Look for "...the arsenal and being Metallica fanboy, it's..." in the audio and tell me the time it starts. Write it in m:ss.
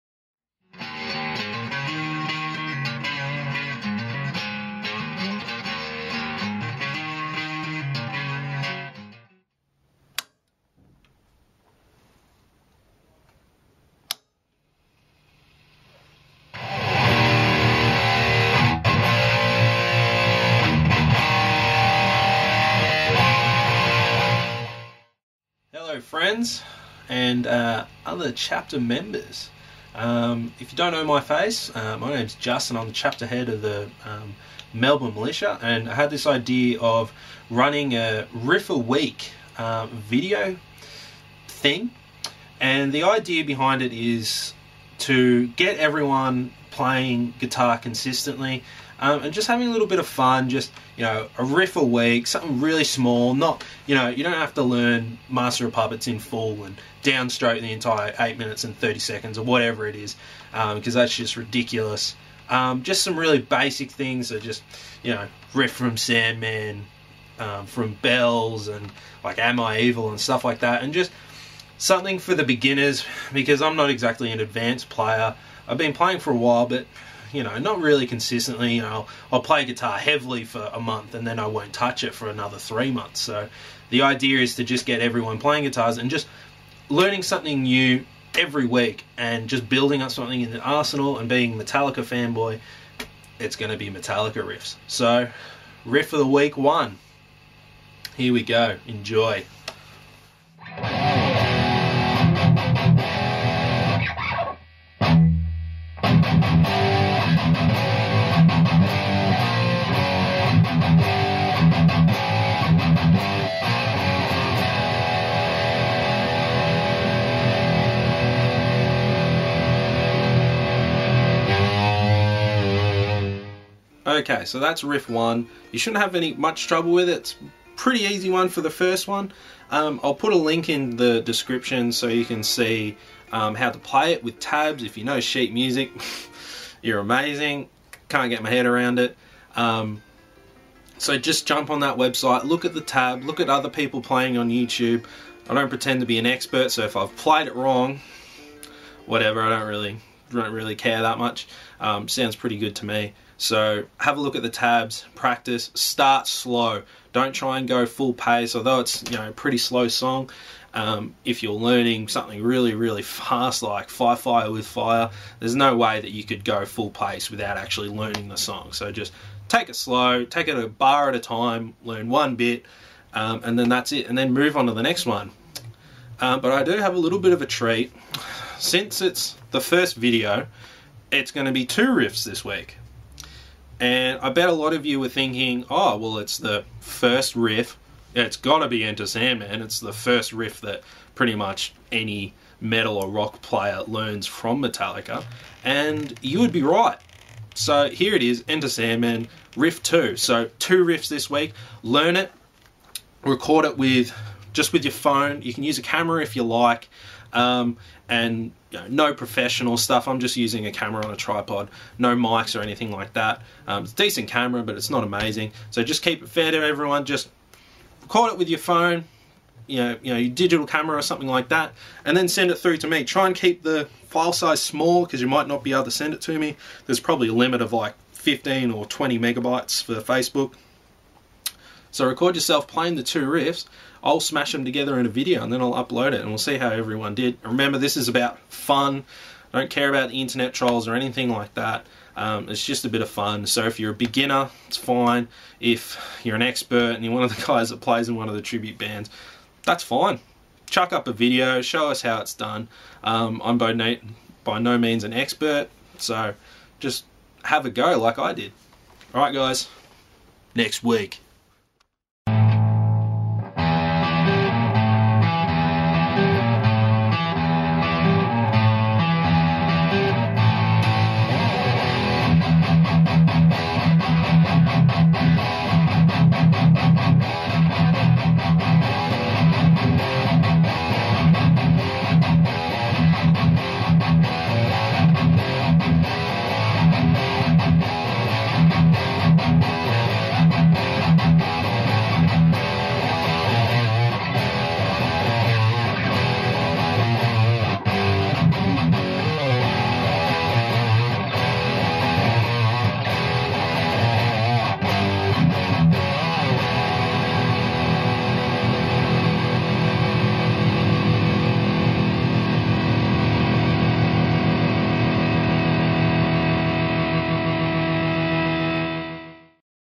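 1:30.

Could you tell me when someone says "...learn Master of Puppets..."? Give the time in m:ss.
0:54.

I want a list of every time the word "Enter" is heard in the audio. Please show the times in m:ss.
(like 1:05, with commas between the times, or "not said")
3:08, 3:18.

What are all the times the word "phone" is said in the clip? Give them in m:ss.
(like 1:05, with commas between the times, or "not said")
3:24, 3:38.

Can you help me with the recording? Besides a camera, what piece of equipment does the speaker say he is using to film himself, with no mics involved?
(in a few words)
tripod.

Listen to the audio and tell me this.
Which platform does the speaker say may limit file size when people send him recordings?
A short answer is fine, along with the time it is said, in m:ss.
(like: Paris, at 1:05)
Facebook, at 3:49.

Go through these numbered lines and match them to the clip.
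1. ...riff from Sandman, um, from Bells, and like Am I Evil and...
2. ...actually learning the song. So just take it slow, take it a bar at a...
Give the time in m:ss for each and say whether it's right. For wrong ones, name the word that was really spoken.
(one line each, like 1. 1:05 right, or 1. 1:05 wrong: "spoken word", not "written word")
1. 1:05 right
2. 2:47 right.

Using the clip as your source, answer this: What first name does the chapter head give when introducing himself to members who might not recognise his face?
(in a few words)
Justin.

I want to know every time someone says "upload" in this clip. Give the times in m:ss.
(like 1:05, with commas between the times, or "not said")
3:55.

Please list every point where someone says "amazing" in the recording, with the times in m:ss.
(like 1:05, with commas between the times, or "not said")
2:16, 3:35.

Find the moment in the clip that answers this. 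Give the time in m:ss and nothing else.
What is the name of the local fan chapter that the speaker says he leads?
0:34.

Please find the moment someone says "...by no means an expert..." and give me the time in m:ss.
4:14.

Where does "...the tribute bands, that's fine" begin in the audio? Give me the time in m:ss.
4:08.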